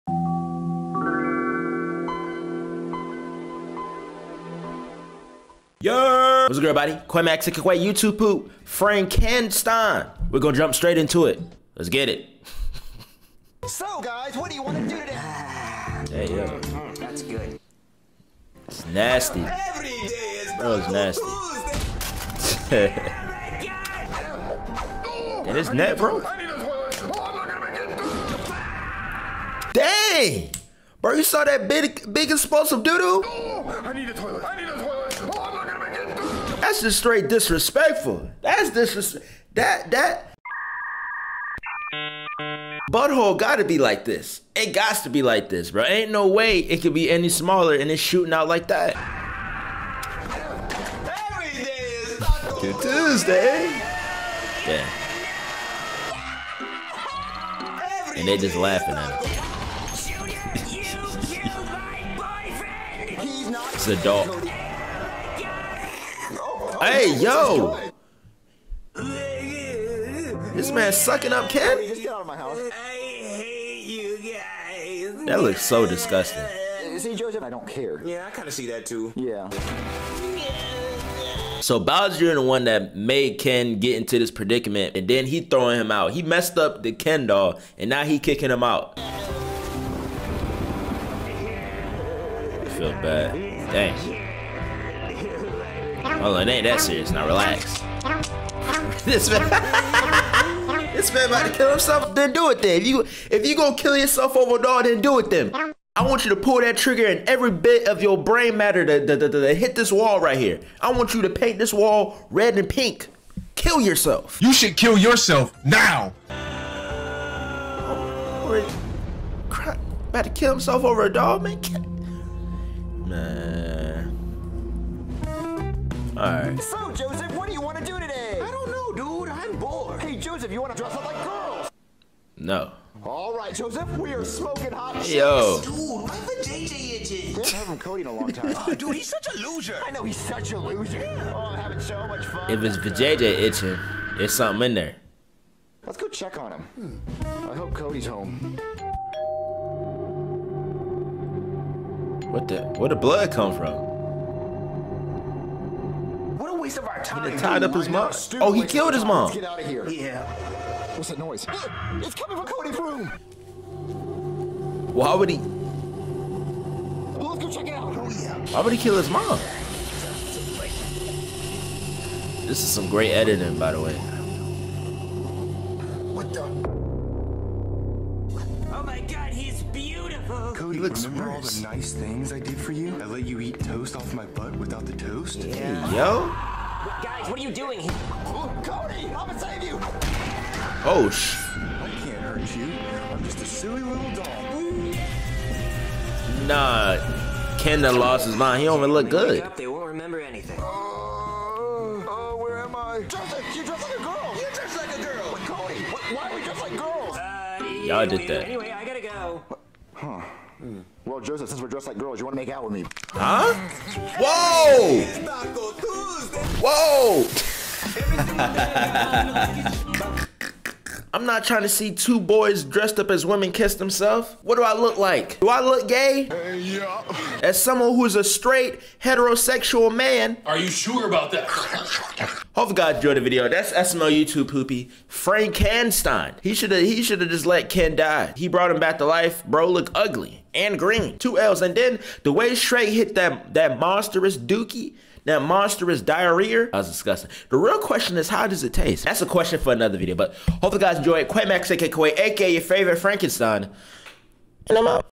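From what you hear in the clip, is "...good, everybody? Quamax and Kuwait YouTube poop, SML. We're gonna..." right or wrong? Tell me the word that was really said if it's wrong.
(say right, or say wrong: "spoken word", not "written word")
wrong: "Frankenstein", not "SML".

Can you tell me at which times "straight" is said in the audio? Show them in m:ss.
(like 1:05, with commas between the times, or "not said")
0:10, 0:36, 3:48.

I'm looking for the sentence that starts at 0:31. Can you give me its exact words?
Bro, you saw that big, big explosive doo-doo?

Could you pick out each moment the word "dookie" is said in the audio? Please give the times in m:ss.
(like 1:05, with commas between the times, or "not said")
4:04.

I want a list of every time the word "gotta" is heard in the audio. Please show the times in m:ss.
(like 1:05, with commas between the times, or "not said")
0:43, 3:28.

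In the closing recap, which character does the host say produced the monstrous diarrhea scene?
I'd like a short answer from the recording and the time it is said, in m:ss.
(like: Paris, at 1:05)
Shrek, at 4:02.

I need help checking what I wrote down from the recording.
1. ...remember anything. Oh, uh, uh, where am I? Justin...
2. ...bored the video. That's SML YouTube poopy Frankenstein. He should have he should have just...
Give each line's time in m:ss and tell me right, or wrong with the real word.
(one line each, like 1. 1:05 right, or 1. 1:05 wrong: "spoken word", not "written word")
1. 3:19 right
2. 3:52 wrong: "enjoyed", not "bored".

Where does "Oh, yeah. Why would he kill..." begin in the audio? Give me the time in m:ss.
2:47.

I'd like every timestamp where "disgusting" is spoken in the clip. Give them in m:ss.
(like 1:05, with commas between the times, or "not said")
1:15, 4:06.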